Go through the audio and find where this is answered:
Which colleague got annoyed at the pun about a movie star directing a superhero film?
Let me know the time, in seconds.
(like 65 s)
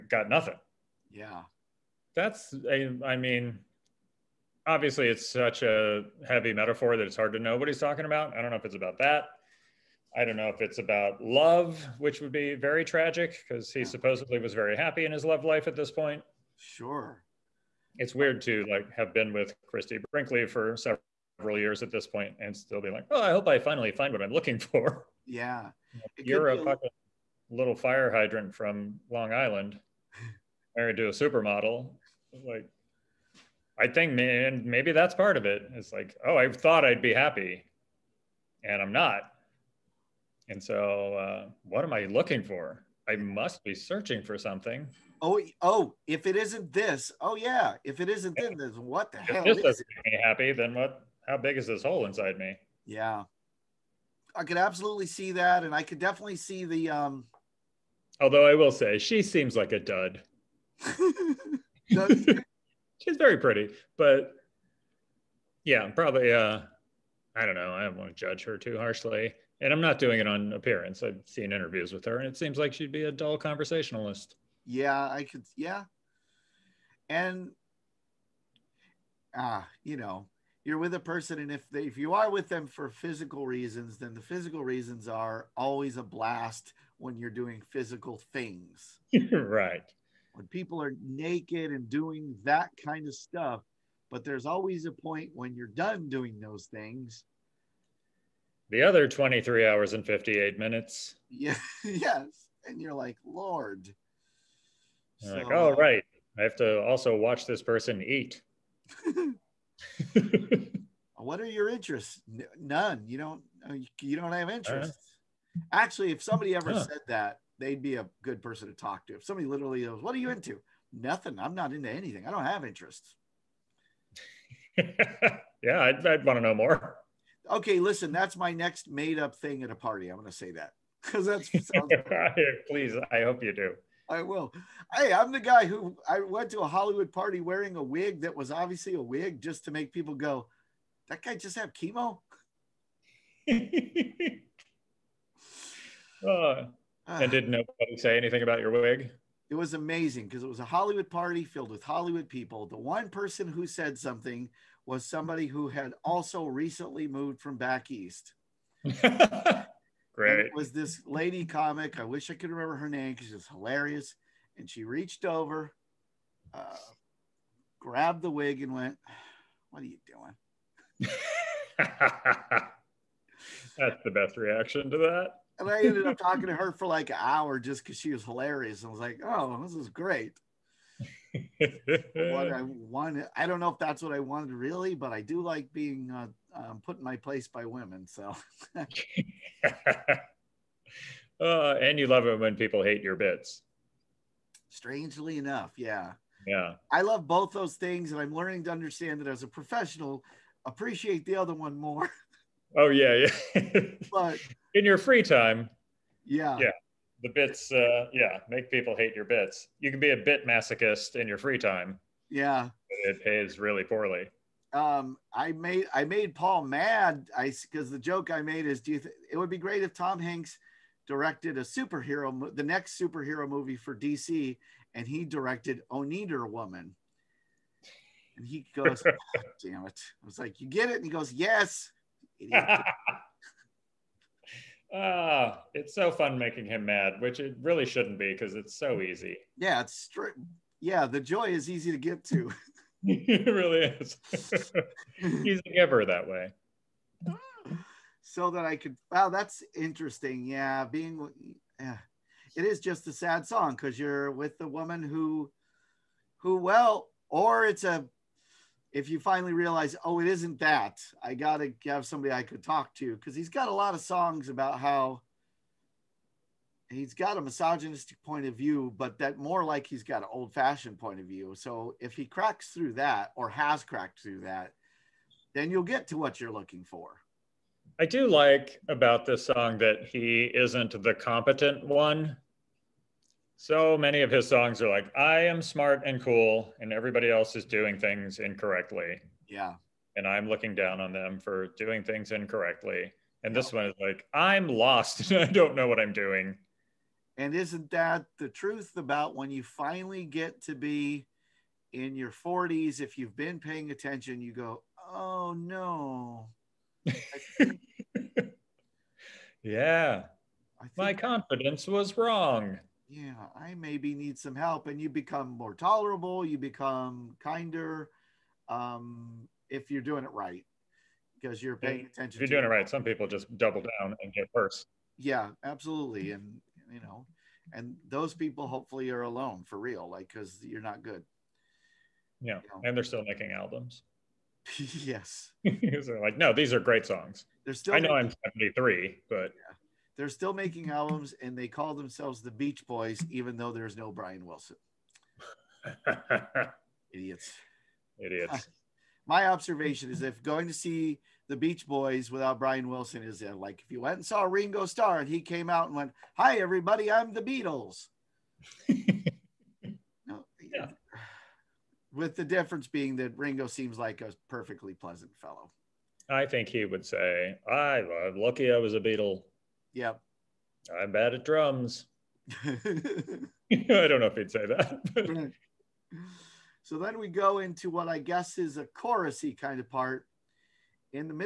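216 s.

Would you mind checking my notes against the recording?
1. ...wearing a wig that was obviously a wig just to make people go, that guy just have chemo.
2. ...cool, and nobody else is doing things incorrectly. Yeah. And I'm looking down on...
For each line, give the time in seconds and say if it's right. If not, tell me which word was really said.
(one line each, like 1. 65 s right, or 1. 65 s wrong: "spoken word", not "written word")
1. 137 s right
2. 286 s wrong: "everybody", not "nobody".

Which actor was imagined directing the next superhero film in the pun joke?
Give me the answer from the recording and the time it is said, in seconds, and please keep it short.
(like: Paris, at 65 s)
Tom Hanks, at 219 s.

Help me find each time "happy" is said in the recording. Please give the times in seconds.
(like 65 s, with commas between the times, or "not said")
14 s, 37 s, 50 s.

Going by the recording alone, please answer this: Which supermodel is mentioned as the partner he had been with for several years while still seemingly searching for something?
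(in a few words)
Christie Brinkley.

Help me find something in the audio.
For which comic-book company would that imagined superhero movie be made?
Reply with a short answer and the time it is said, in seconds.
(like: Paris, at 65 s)
DC, at 223 s.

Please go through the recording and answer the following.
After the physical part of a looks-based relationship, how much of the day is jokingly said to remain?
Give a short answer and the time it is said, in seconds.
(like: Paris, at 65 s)
23 hours and 58 minutes, at 99 s.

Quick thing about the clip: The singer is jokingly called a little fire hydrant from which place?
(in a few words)
Long Island.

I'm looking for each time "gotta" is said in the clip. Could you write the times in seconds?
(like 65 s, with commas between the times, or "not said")
261 s.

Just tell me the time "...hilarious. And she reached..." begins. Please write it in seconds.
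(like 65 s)
163 s.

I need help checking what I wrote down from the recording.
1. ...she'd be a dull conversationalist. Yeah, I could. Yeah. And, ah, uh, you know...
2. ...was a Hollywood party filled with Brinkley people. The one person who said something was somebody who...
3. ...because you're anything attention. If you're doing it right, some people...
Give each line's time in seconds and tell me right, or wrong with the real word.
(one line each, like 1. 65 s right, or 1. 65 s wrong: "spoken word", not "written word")
1. 72 s right
2. 150 s wrong: "Hollywood", not "Brinkley"
3. 321 s wrong: "paying", not "anything".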